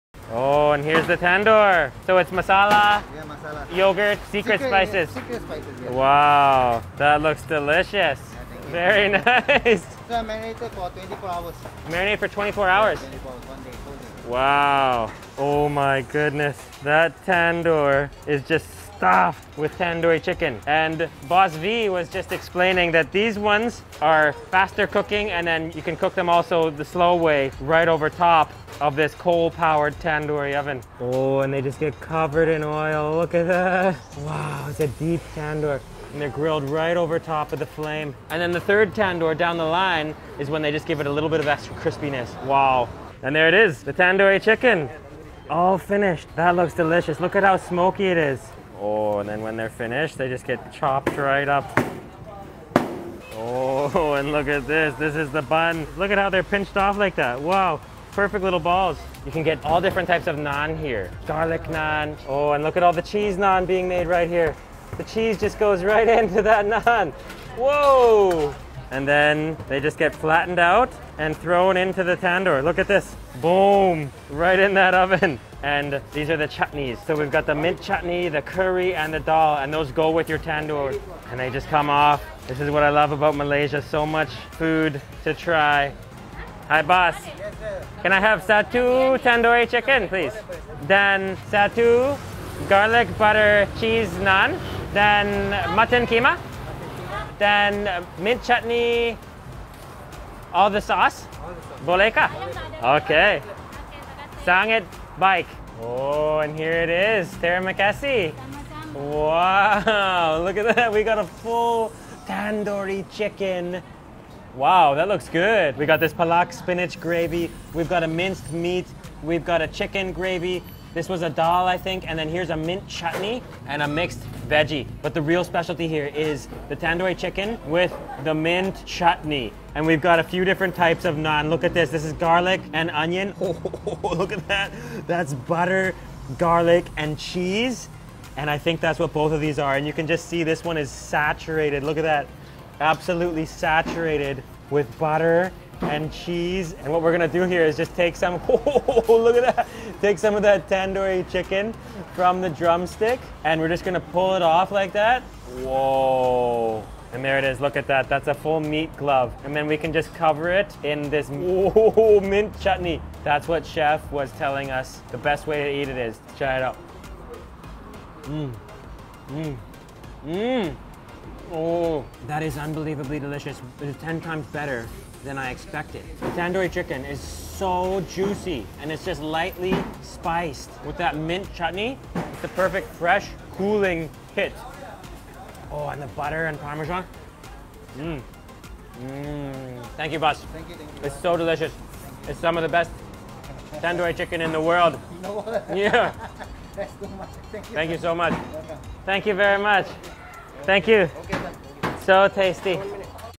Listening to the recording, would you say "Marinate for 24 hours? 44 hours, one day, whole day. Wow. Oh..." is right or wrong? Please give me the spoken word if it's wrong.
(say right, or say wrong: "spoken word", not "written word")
wrong: "24", not "44".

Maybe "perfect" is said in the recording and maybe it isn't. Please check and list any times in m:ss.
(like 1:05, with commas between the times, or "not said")
0:58, 3:02.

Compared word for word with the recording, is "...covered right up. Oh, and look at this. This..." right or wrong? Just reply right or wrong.
wrong.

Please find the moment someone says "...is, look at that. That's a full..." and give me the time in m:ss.
2:37.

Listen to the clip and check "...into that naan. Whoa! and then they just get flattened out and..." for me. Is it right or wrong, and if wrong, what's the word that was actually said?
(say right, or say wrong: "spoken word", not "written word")
right.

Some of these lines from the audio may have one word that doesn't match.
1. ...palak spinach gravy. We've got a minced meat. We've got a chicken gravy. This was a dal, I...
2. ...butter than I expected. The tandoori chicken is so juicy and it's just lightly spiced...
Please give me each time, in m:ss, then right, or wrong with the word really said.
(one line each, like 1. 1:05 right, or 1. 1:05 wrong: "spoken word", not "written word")
1. 1:56 right
2. 2:54 wrong: "better", not "butter".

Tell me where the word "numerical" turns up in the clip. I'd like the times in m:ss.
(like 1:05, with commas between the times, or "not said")
not said.